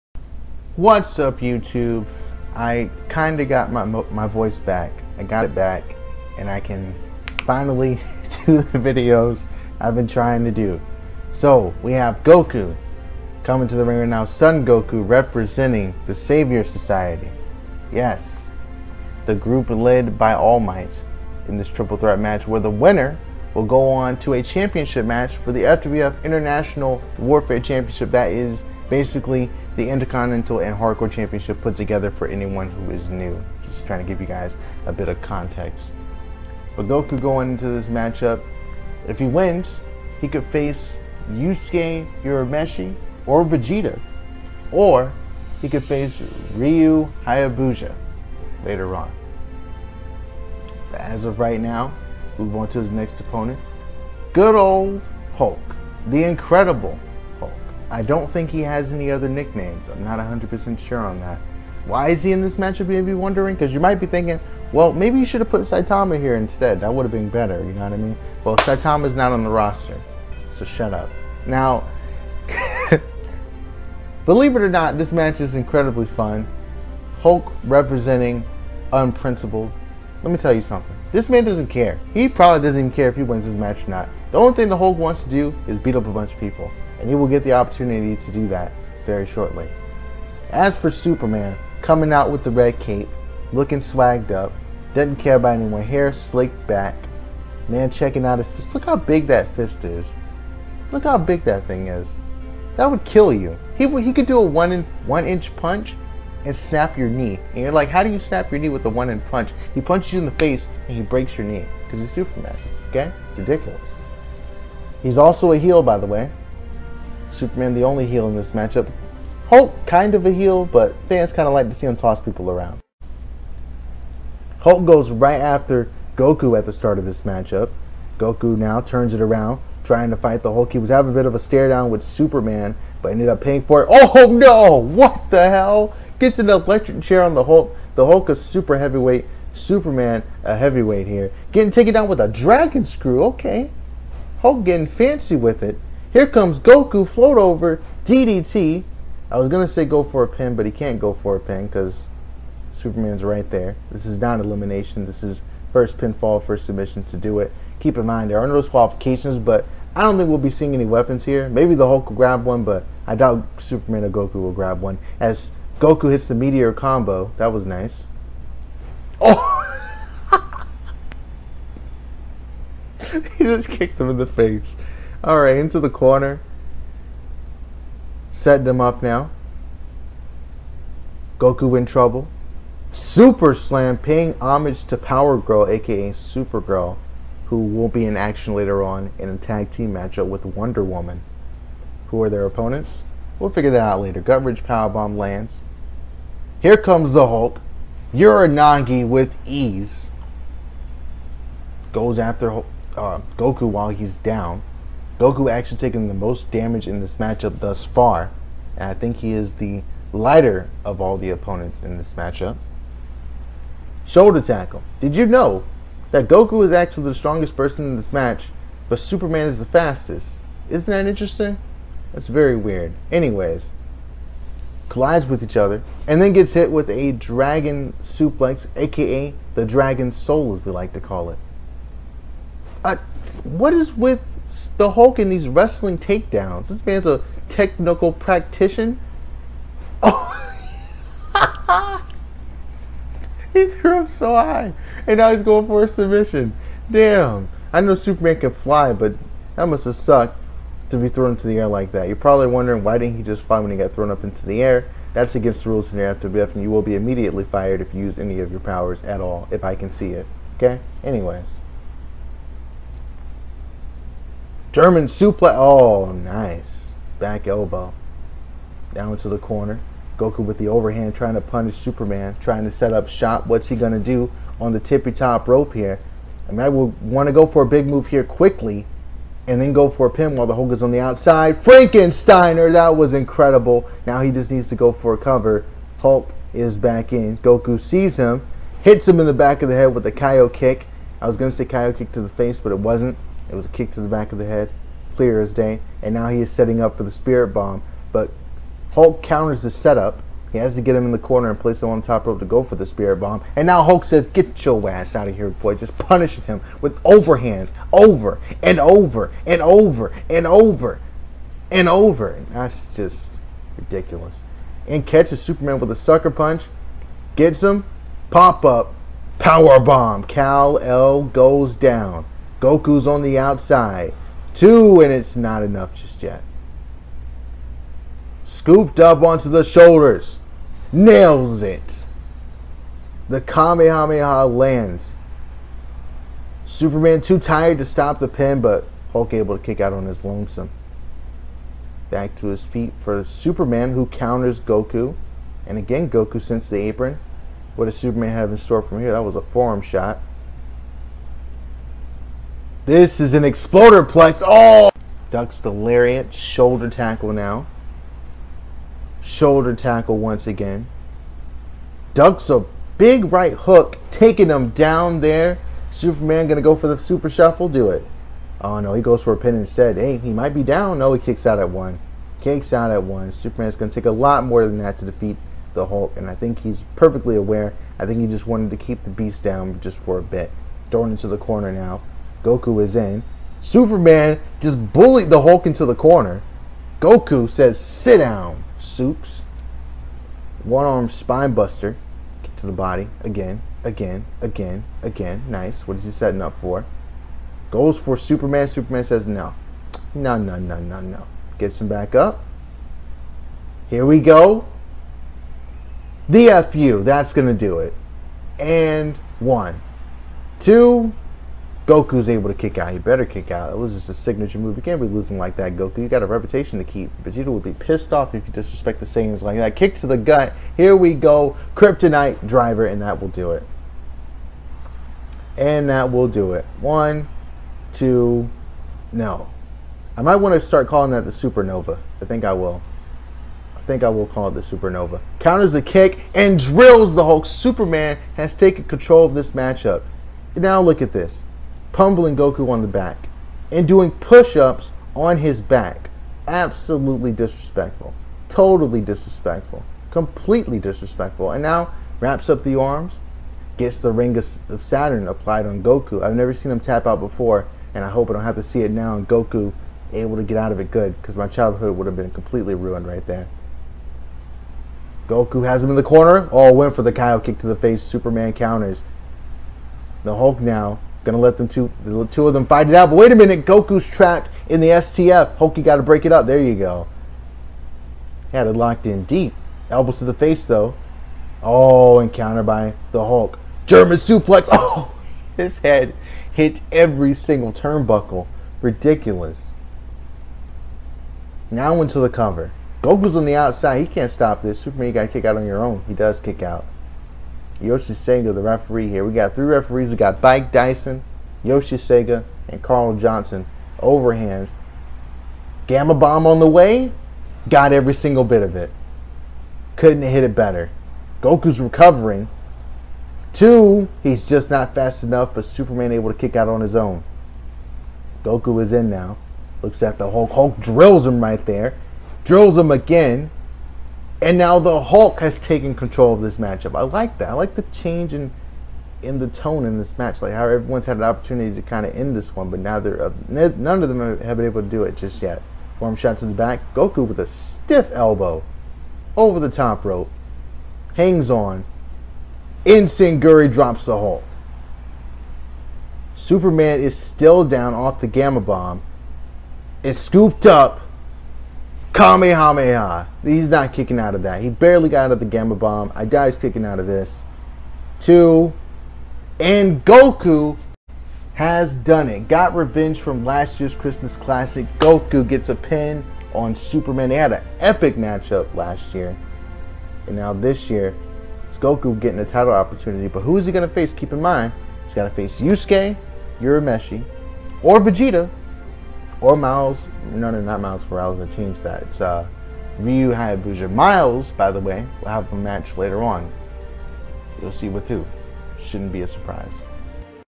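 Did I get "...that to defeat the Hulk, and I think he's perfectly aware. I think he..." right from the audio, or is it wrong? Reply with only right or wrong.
right.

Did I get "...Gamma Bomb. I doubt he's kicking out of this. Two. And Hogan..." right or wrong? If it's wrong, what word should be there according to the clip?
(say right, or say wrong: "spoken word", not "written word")
wrong: "Goku", not "Hogan".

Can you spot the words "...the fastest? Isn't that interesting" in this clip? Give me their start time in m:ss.
3:39.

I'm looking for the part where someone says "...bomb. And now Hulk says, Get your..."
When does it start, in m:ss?
5:03.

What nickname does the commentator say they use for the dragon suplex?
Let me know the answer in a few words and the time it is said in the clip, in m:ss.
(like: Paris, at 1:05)
Dragon soul, at 3:49.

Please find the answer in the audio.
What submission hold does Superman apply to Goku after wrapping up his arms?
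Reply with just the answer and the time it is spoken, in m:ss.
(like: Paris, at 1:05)
Ring of Saturn, at 7:34.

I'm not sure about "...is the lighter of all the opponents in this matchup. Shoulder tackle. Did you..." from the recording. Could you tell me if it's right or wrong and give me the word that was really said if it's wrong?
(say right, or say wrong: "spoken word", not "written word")
right.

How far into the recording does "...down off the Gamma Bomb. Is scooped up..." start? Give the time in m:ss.
9:07.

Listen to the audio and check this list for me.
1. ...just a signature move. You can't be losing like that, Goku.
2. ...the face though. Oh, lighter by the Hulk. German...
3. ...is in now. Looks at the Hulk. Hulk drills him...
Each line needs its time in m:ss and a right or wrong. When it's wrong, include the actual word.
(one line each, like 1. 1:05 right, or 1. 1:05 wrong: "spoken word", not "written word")
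1. 6:53 right
2. 8:00 wrong: "encounter", not "lighter"
3. 8:38 right.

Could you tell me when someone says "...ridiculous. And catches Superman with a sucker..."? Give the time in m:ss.
5:13.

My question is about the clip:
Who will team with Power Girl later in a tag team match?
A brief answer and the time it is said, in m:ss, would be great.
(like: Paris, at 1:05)
Wonder Woman, at 3:10.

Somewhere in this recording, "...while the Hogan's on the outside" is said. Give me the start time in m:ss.
4:40.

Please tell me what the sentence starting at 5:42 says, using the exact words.
Back to his feet for Superman, who counters Goku.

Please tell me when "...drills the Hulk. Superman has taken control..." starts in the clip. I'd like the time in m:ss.
7:16.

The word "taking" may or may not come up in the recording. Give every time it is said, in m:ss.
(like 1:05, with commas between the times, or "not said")
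3:25, 6:04.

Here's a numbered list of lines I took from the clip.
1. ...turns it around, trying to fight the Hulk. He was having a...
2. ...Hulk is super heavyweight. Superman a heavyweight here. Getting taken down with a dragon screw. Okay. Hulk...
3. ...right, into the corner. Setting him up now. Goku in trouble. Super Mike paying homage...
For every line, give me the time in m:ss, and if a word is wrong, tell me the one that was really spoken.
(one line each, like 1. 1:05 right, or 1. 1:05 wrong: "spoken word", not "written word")
1. 2:08 right
2. 2:18 right
3. 2:55 wrong: "Slam", not "Mike".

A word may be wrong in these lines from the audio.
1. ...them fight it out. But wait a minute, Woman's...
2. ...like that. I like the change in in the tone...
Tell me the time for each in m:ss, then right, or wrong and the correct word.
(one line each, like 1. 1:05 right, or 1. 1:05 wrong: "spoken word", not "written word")
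1. 7:52 wrong: "Goku", not "Woman"
2. 8:47 right.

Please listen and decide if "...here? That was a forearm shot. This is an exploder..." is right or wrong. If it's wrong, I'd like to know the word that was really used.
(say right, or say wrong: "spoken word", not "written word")
right.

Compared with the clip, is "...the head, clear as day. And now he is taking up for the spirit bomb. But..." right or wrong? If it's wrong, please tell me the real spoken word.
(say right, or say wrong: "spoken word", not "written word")
wrong: "setting", not "taking".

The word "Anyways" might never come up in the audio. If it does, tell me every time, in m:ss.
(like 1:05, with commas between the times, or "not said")
3:43, 4:21.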